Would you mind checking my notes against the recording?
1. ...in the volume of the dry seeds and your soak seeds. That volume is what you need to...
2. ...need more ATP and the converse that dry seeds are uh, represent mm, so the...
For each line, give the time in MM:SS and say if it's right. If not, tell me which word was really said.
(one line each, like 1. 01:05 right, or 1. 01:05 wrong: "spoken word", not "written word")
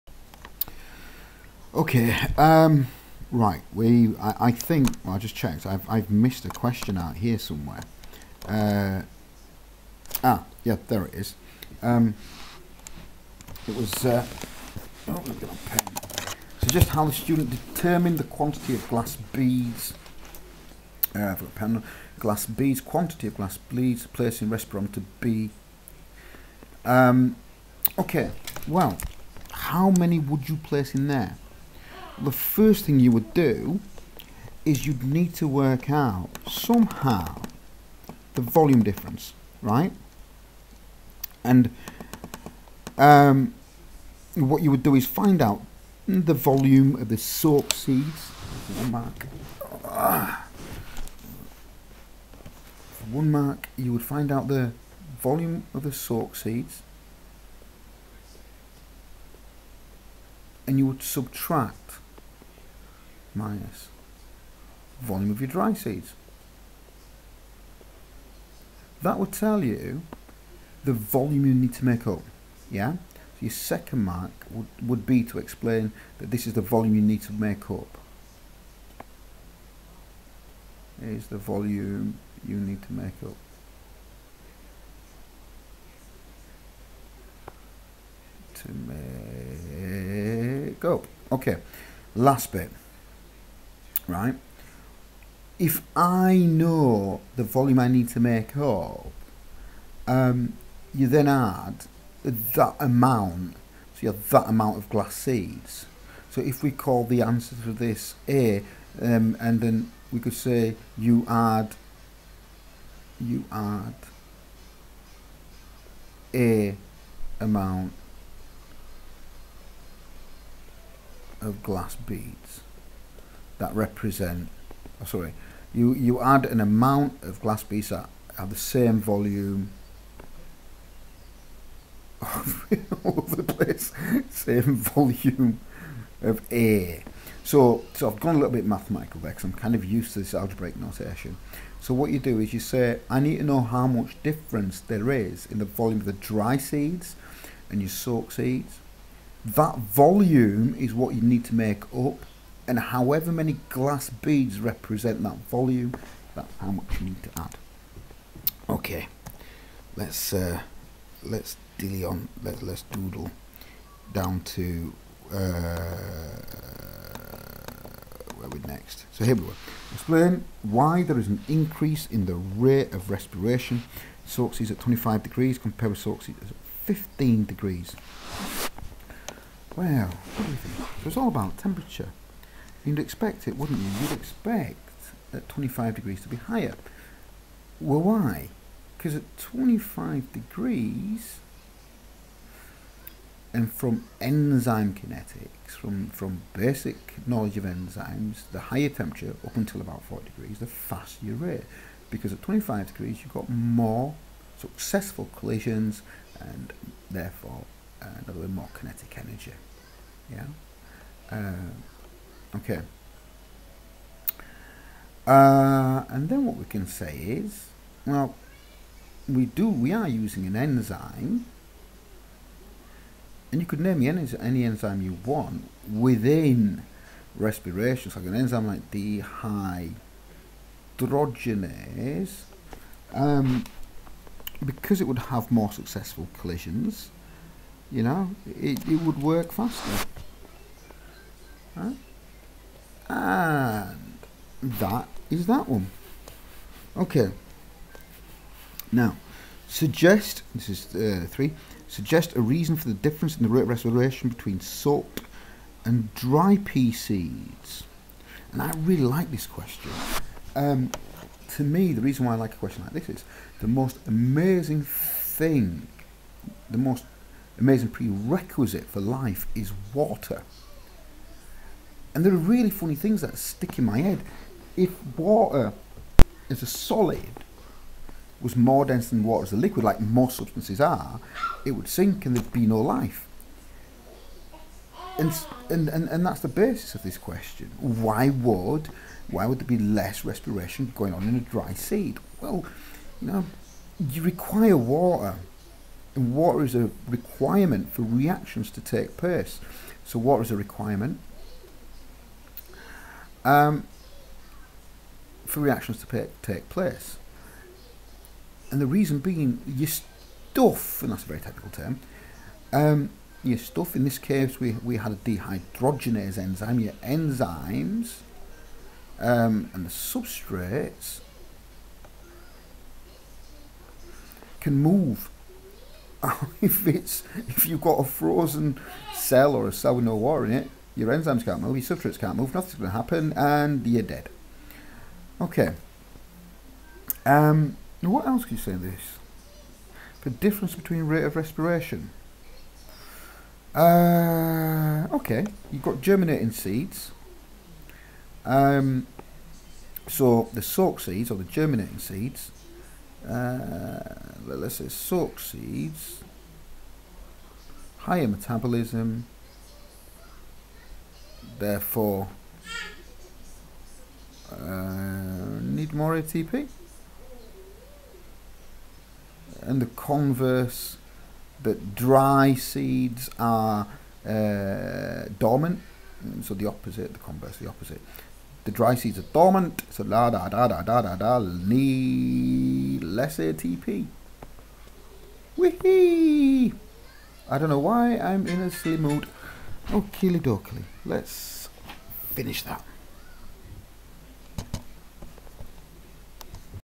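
1. 02:25 right
2. 06:05 wrong: "dormant", not "represent".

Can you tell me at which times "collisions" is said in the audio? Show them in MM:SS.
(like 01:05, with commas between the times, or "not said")
03:25, 03:56.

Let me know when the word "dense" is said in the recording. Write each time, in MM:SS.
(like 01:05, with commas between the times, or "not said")
04:38.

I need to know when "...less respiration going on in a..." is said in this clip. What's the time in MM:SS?
04:49.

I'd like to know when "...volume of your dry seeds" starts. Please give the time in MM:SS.
01:05.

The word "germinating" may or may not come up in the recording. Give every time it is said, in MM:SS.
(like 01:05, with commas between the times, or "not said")
05:46, 05:51.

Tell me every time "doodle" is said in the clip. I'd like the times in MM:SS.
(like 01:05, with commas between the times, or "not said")
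02:42.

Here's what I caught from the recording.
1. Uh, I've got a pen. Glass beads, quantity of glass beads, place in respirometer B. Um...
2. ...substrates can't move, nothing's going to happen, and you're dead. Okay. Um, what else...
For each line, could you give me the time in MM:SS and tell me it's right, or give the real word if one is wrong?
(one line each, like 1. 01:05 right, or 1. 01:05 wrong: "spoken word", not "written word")
1. 00:21 right
2. 05:31 right.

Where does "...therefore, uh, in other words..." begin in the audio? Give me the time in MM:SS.
03:27.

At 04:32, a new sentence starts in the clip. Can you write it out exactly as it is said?
And there are really funny things that stick in my head.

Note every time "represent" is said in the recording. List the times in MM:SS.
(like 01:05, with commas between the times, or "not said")
02:03, 02:34.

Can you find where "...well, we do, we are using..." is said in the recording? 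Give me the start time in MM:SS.
03:38.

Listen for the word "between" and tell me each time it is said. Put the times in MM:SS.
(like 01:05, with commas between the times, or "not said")
04:14, 05:40.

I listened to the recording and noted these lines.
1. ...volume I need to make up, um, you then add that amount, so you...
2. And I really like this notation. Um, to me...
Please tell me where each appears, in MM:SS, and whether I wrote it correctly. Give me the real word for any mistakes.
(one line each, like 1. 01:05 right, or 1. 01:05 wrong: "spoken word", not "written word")
1. 01:37 right
2. 04:18 wrong: "question", not "notation".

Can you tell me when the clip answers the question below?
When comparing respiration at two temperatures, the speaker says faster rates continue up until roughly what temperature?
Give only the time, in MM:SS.
03:20.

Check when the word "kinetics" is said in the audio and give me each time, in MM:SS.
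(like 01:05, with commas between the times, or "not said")
03:14, 03:28.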